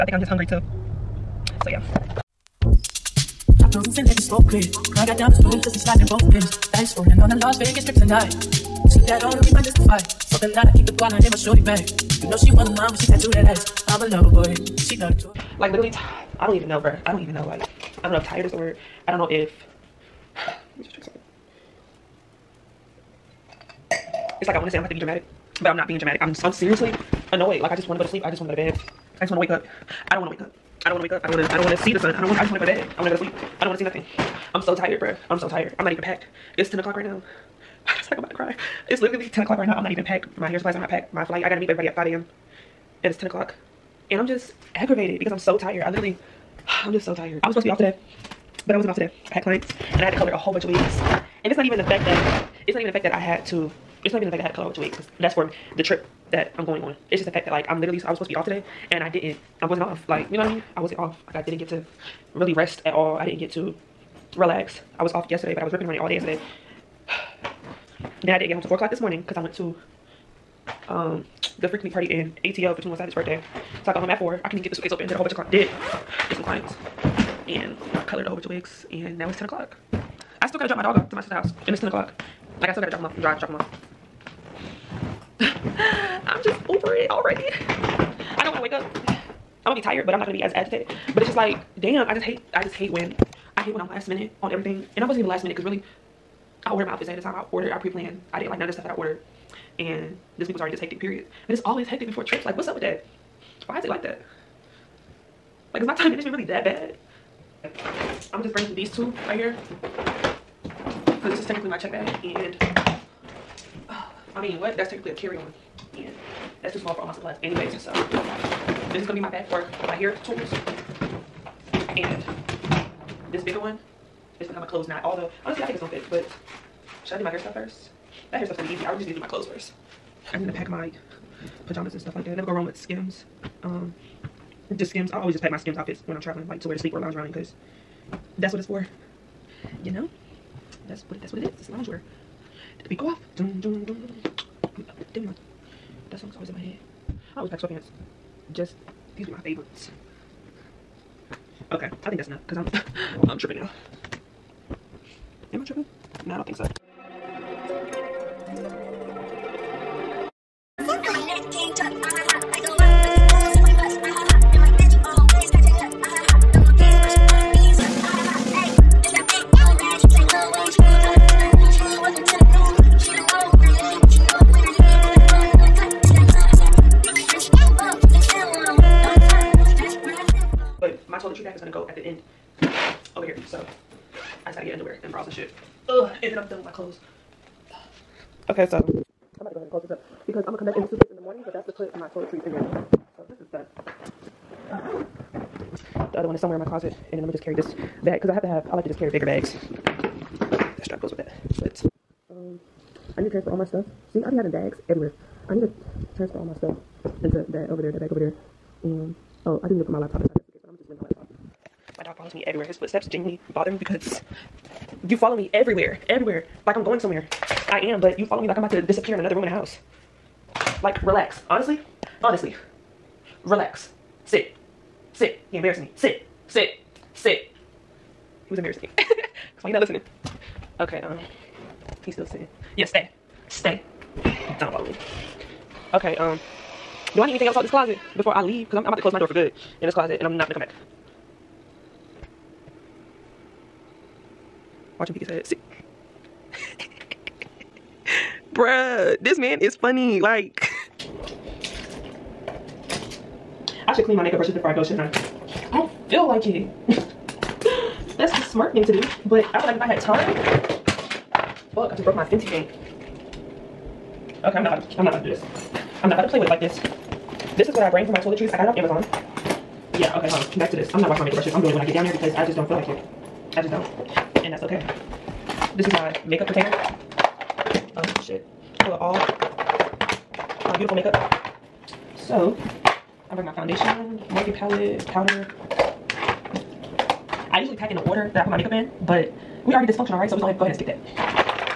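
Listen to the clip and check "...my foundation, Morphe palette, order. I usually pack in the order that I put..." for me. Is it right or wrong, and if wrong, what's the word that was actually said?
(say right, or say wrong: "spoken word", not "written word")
wrong: "powder", not "order".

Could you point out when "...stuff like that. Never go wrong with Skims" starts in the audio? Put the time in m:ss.
2:12.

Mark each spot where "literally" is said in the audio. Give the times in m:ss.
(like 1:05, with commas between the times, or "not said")
0:15, 0:39, 0:45, 0:57.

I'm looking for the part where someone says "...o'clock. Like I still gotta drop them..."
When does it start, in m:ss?
1:21.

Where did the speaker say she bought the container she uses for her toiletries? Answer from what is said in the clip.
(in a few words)
Amazon.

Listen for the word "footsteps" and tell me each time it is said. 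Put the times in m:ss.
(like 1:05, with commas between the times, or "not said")
3:32.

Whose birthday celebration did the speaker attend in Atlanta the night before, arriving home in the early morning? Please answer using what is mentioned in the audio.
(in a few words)
21 Savage.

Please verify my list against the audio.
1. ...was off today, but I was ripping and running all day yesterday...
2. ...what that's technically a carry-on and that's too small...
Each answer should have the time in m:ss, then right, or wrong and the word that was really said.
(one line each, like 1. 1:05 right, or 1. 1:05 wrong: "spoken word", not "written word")
1. 1:05 wrong: "yesterday", not "today"
2. 1:54 right.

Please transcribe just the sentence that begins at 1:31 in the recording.
But it's just like, damn, I just hate, I just hate when, I hate when I'm last minute on everything.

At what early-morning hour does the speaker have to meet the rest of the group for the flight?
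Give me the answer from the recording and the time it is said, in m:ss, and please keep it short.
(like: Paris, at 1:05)
5 a.m., at 0:41.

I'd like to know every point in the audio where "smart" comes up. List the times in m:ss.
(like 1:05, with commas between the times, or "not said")
4:18.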